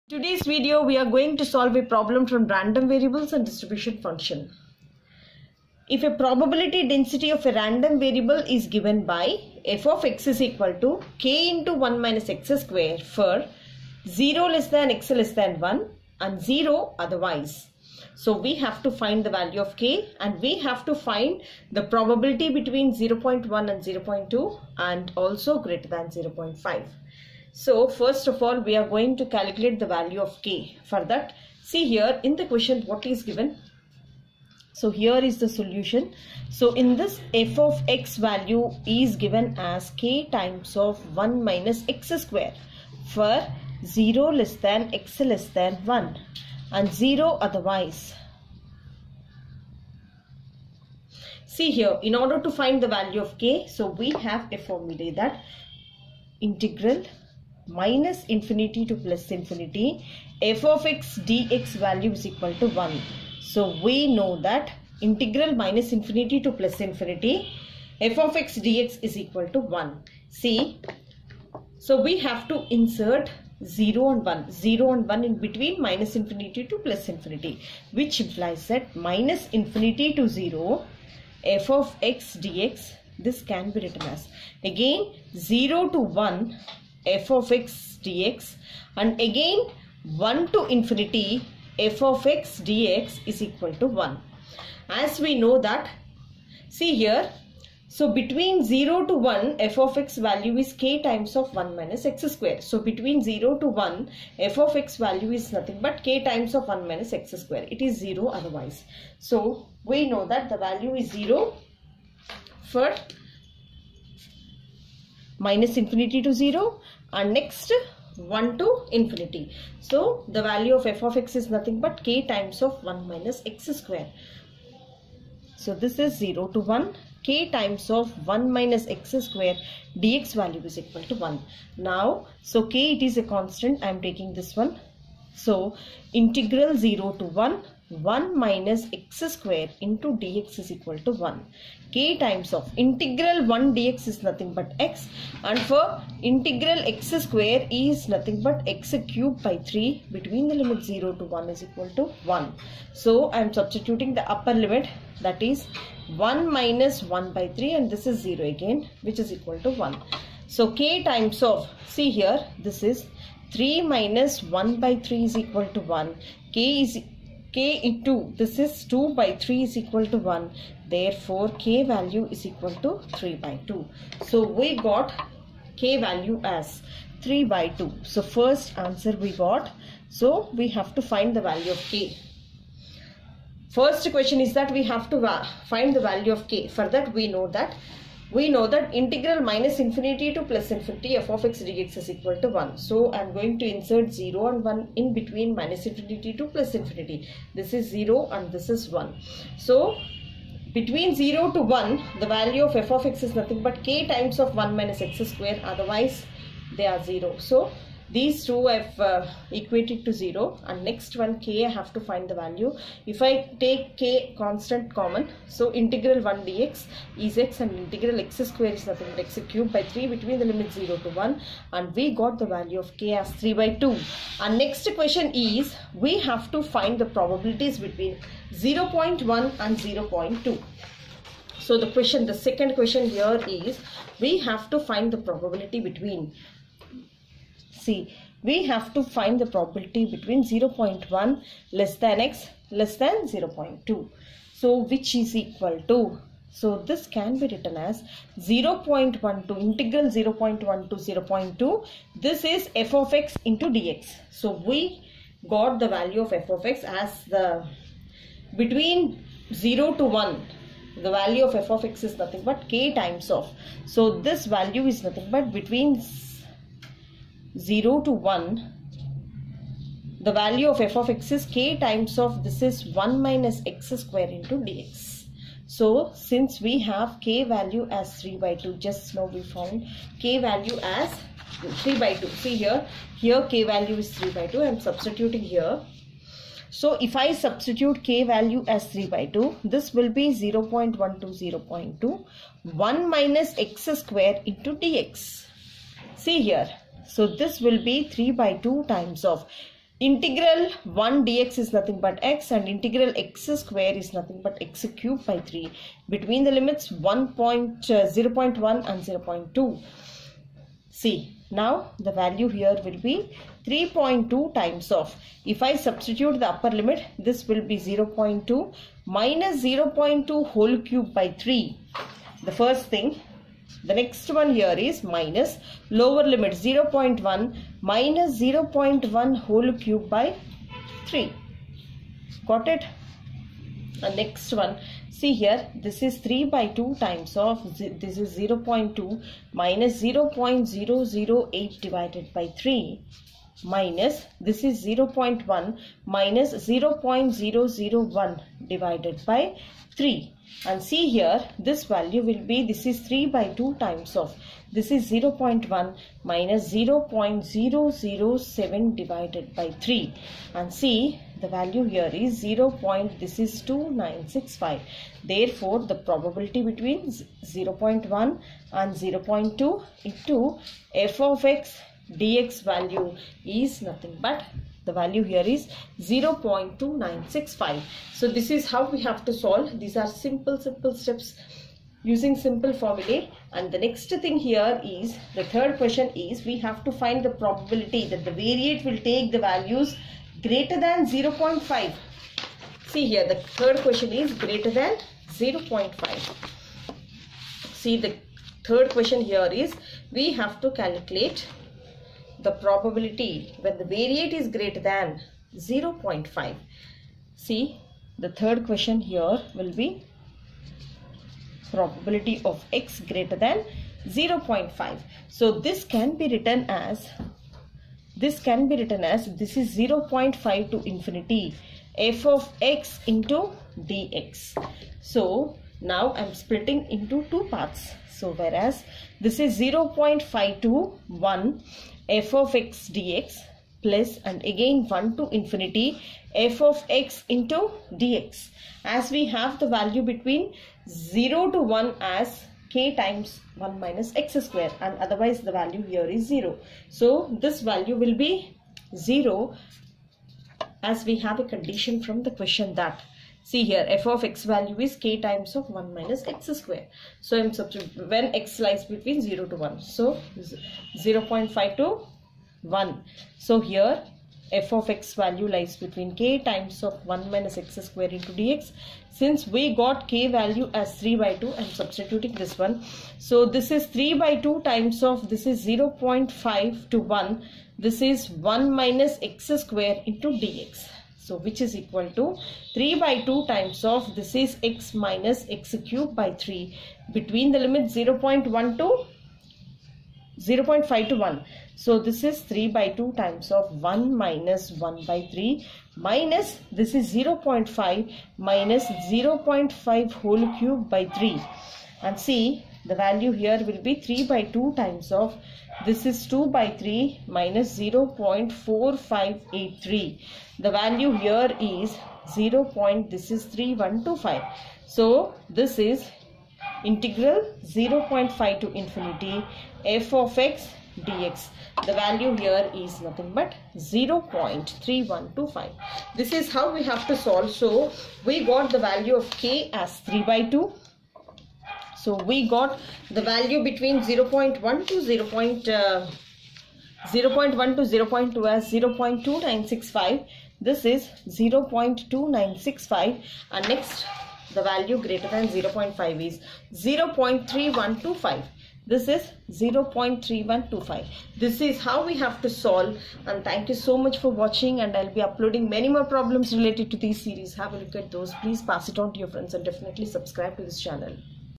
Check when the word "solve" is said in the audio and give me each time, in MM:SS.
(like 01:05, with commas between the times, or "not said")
00:01, 06:19, 08:47, 09:12.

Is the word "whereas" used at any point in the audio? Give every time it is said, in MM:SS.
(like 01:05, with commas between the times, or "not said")
07:08.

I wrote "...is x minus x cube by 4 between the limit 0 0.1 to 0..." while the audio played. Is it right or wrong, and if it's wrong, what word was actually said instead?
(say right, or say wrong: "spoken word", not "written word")
wrong: "3", not "4".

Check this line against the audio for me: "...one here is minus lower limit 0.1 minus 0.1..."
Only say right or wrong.
right.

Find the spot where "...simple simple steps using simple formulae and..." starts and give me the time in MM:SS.
06:20.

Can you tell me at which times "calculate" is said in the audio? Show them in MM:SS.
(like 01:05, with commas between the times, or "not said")
00:29, 06:40.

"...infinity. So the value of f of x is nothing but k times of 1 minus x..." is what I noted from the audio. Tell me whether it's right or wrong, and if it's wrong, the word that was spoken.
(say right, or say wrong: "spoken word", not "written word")
right.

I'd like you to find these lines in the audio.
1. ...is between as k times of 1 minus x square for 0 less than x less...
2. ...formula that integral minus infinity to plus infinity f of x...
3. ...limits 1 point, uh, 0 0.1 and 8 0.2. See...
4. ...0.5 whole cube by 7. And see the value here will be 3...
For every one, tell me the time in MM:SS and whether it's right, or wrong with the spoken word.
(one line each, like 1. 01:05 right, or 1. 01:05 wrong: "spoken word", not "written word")
1. 00:38 wrong: "given", not "between"
2. 00:54 right
3. 05:06 wrong: "0", not "8"
4. 08:19 wrong: "3", not "7".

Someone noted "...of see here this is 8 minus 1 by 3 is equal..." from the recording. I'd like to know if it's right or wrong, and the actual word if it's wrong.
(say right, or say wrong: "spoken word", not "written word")
wrong: "3", not "8".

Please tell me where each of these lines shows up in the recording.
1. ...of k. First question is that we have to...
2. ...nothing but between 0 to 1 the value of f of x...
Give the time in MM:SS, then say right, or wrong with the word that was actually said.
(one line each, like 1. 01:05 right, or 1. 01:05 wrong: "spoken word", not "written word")
1. 03:01 right
2. 04:25 right.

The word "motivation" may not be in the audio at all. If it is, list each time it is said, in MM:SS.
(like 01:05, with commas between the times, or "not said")
not said.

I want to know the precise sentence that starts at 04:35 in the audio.
So since we have k value as 3 by 2 just now we found k value as 3 by 2.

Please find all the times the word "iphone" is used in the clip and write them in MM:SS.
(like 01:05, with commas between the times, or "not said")
not said.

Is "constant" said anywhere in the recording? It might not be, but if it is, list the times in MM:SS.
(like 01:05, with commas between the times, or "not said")
02:13, 03:34.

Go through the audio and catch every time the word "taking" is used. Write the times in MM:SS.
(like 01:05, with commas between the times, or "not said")
02:14.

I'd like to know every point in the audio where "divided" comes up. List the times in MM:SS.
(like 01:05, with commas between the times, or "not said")
05:41, 05:48, 05:59.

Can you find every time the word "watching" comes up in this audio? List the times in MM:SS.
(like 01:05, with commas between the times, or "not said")
09:14.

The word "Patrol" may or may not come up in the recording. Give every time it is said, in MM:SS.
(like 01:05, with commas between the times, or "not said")
not said.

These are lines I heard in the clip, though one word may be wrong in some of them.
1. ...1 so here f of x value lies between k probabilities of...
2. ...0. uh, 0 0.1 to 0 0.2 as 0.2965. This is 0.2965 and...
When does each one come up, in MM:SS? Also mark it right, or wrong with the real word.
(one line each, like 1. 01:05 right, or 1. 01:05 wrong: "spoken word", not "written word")
1. 07:42 wrong: "times", not "probabilities"
2. 08:55 right.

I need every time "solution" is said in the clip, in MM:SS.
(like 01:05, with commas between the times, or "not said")
00:35.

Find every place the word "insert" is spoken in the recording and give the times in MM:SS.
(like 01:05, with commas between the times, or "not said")
01:12, 03:13.